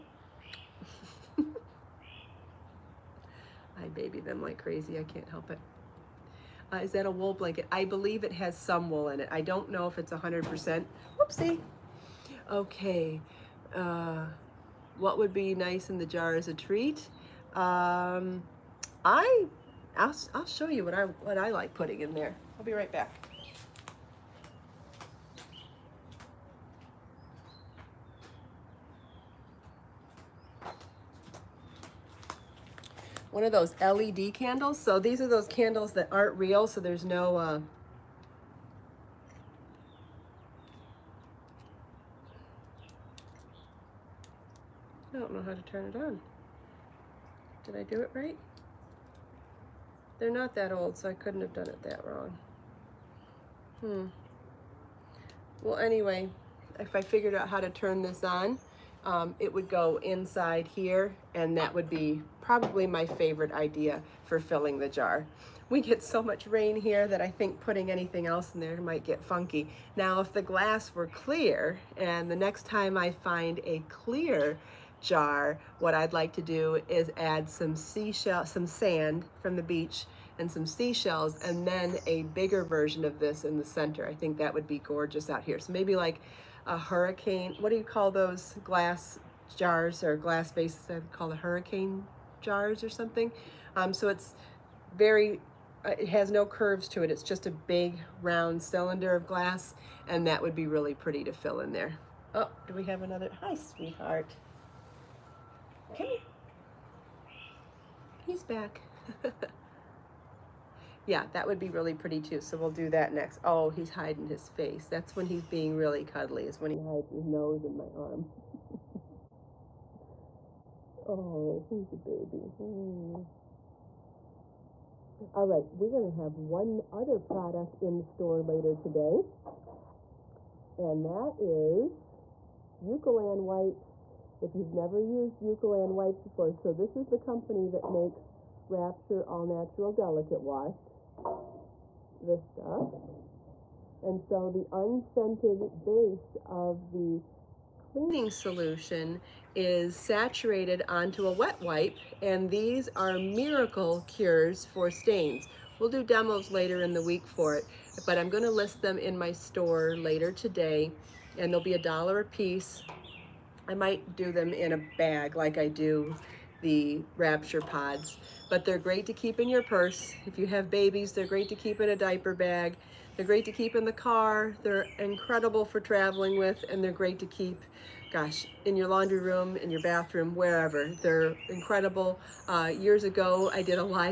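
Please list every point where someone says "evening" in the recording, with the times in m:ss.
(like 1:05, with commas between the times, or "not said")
not said.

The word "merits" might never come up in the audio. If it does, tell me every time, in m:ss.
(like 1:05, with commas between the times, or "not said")
not said.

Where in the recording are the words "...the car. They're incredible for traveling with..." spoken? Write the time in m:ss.
2:53.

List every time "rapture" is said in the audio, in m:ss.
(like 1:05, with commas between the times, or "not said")
2:18, 2:47.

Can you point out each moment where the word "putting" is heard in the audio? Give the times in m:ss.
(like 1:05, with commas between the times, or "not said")
0:21, 1:07.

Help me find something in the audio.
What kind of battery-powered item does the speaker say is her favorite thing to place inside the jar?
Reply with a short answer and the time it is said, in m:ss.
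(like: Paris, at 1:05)
LED candles, at 0:33.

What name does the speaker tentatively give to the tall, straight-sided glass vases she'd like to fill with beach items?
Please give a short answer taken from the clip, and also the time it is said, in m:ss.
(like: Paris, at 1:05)
hurricane jars, at 1:31.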